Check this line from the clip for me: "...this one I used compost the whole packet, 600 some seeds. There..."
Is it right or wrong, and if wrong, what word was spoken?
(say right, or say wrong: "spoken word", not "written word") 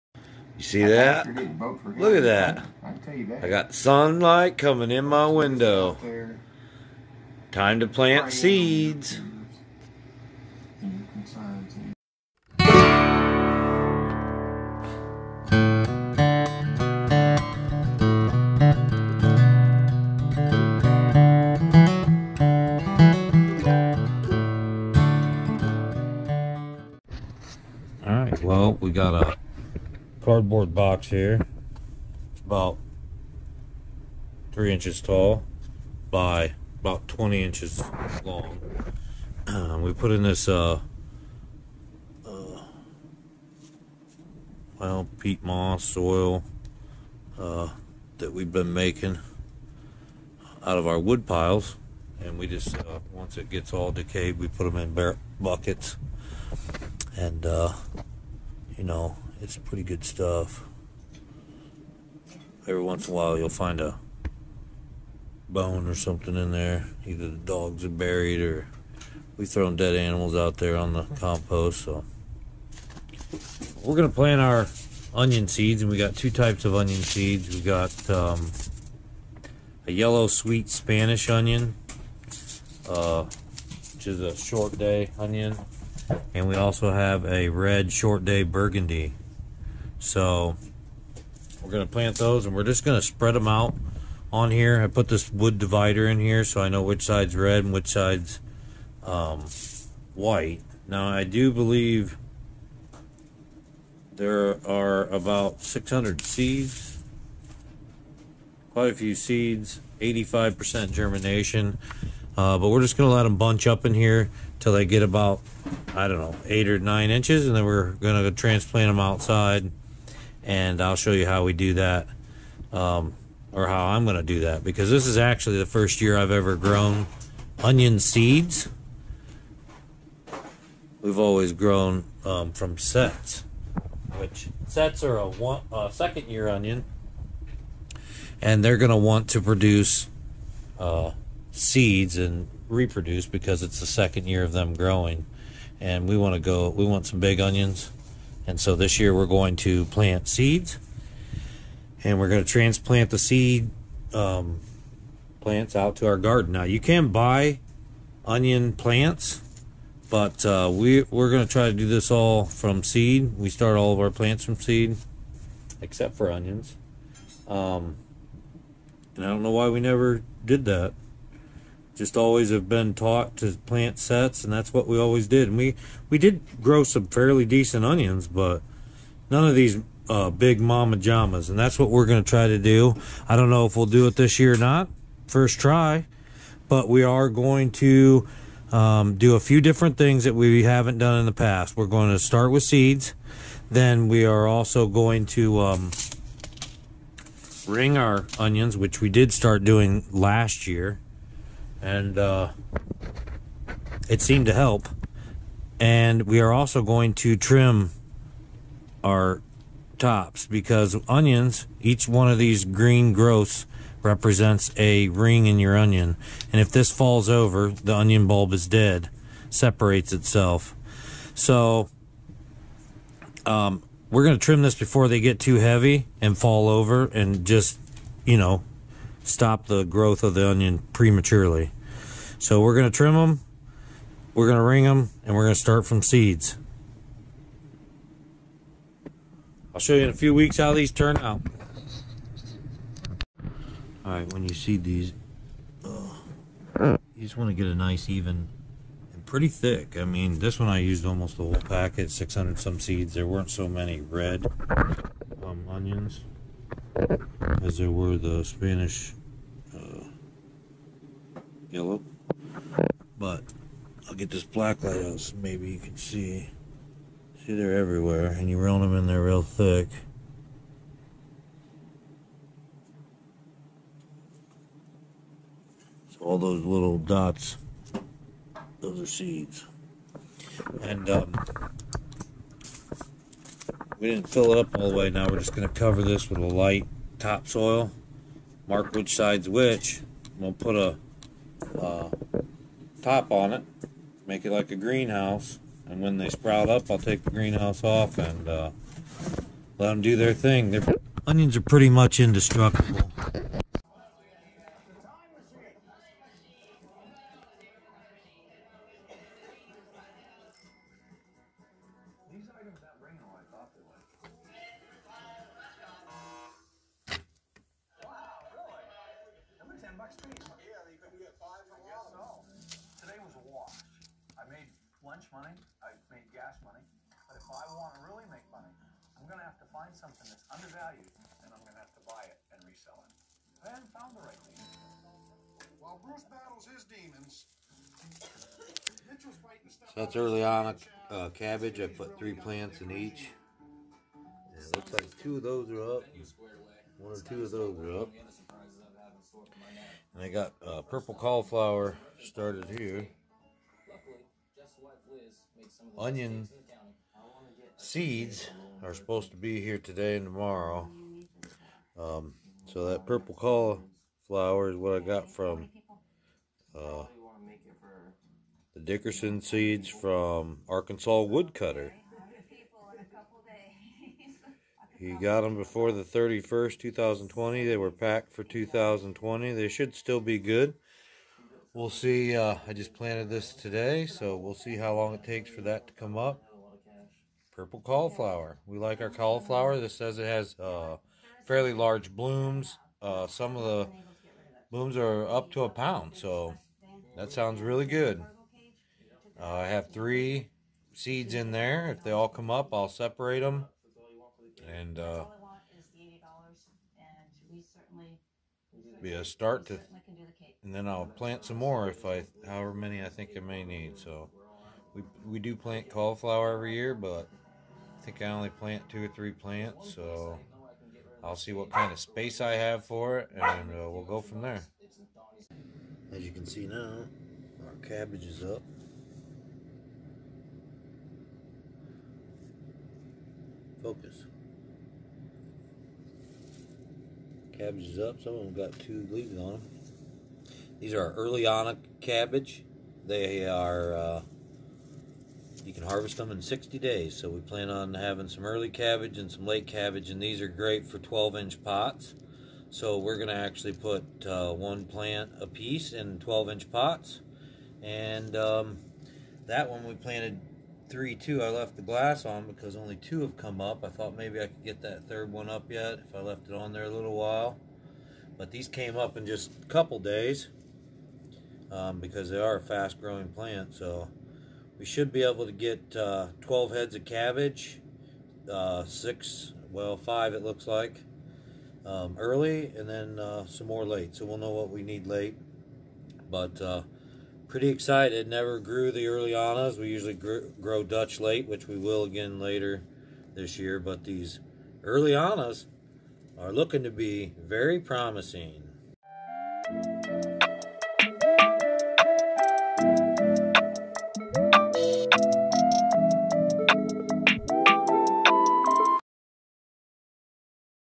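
wrong: "almost", not "compost".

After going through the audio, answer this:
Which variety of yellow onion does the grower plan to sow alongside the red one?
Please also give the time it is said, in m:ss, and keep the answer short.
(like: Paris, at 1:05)
sweet Spanish, at 1:20.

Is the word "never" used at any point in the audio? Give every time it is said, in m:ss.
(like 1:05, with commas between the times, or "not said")
2:49, 8:08.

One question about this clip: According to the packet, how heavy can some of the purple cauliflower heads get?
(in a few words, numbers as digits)
a pound.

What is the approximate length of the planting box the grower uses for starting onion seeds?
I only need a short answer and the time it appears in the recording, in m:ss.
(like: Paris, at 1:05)
20 inches, at 0:37.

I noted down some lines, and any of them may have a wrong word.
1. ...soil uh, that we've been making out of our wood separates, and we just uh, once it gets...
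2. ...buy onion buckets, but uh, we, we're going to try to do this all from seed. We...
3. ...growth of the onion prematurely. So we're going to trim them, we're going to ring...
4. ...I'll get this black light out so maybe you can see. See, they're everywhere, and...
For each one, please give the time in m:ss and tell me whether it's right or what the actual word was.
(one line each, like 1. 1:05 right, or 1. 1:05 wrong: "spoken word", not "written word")
1. 0:45 wrong: "piles", not "separates"
2. 2:37 wrong: "plants", not "buckets"
3. 3:49 right
4. 4:24 right.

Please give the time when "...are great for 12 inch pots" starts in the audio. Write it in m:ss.
7:30.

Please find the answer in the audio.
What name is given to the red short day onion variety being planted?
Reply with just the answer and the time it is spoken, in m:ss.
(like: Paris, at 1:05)
burgundy, at 1:28.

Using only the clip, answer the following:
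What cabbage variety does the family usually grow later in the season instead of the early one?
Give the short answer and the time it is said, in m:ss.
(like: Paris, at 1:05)
Dutch late, at 8:10.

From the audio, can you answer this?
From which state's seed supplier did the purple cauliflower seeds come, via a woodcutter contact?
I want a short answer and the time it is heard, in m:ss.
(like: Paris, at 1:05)
Arkansas, at 6:10.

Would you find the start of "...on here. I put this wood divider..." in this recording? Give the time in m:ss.
1:34.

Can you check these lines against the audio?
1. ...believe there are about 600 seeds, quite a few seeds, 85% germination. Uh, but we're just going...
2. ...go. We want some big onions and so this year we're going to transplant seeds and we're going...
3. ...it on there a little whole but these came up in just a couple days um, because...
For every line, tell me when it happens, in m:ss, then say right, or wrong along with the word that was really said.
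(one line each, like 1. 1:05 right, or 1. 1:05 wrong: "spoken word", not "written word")
1. 1:41 right
2. 2:26 wrong: "plant", not "transplant"
3. 7:46 wrong: "while", not "whole".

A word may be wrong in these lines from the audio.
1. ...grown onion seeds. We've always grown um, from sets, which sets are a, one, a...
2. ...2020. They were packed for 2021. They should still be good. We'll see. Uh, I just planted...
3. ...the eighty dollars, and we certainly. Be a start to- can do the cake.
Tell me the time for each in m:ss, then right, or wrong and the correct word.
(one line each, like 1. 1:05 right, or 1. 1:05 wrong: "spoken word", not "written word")
1. 2:06 right
2. 6:16 wrong: "2020", not "2021"
3. 6:45 right.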